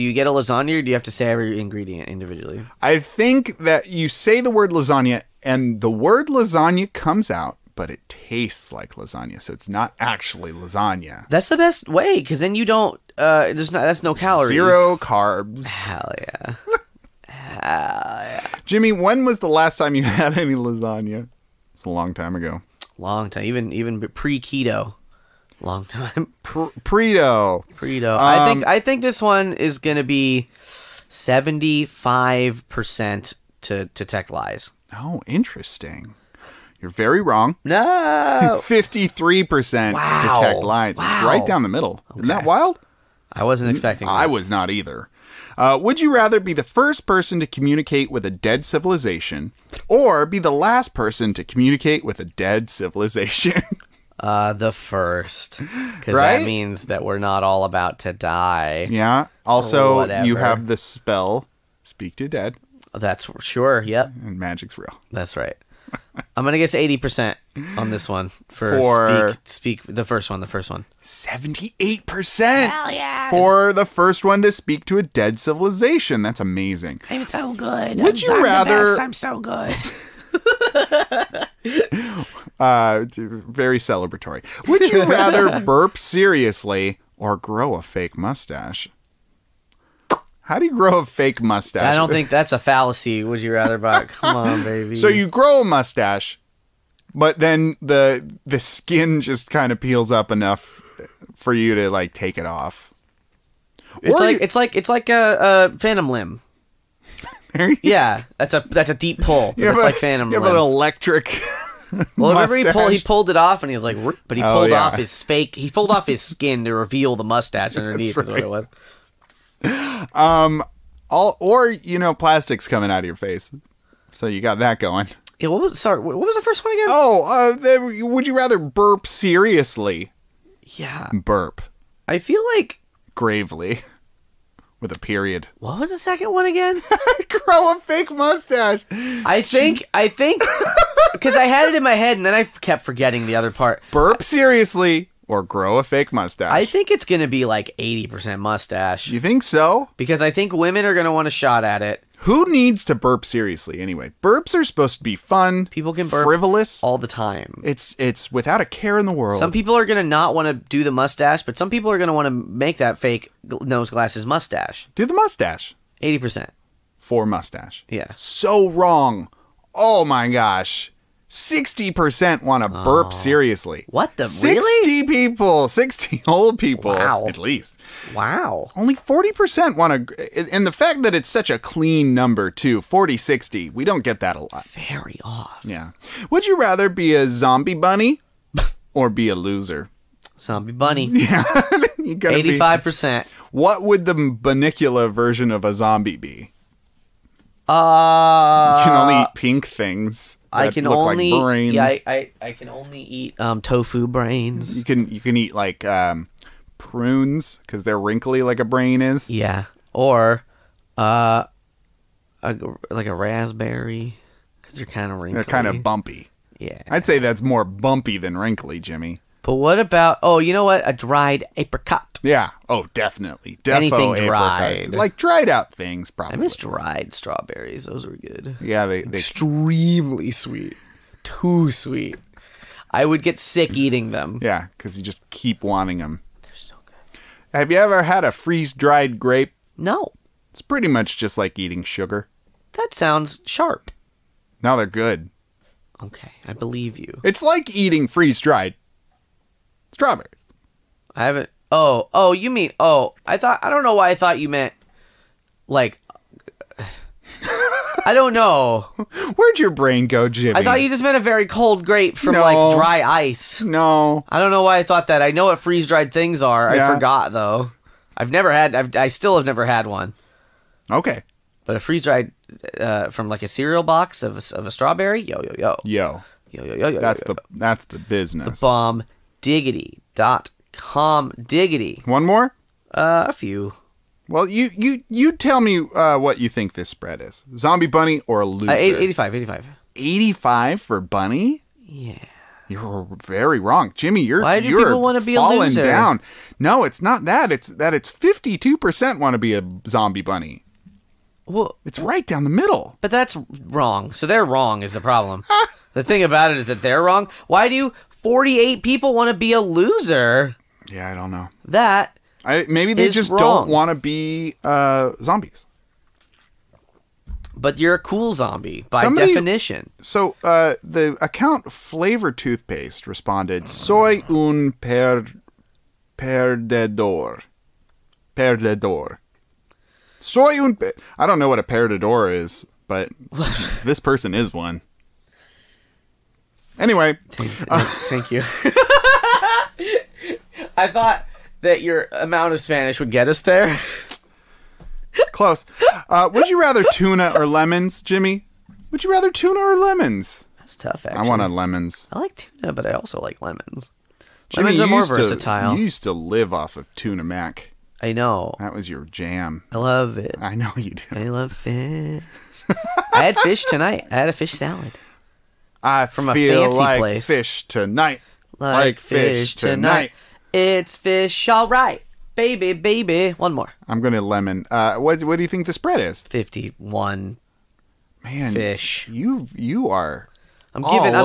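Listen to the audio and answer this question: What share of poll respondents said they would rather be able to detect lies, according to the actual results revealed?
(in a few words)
53%.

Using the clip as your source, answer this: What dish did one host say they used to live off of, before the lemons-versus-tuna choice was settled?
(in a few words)
Tuna mac.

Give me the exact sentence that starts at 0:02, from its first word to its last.
I think that you say the word lasagna and the word lasagna comes out, but it tastes like lasagna.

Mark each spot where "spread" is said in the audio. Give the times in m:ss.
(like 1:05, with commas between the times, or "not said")
4:46, 6:15.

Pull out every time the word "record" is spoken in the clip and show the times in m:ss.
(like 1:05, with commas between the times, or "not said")
not said.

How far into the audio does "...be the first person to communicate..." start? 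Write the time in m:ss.
0:46.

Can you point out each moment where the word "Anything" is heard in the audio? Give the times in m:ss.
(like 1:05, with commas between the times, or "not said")
3:43.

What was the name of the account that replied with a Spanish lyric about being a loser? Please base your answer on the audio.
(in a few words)
Flavor Toothpaste.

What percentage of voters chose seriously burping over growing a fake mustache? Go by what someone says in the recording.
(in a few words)
60%.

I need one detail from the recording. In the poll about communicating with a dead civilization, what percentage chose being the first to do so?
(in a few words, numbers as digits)
78%.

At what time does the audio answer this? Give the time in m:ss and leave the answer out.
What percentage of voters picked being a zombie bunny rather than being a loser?
4:58.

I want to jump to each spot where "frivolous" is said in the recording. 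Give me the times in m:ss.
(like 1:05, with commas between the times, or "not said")
2:36.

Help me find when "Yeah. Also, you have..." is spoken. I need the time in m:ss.
0:58.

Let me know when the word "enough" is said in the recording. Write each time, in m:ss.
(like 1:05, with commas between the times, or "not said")
1:40.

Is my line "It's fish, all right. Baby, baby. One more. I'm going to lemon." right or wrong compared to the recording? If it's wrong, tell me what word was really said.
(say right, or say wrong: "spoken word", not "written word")
right.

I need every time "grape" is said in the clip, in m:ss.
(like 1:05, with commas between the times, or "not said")
3:59, 4:21.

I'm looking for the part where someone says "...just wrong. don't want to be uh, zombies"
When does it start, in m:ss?
5:13.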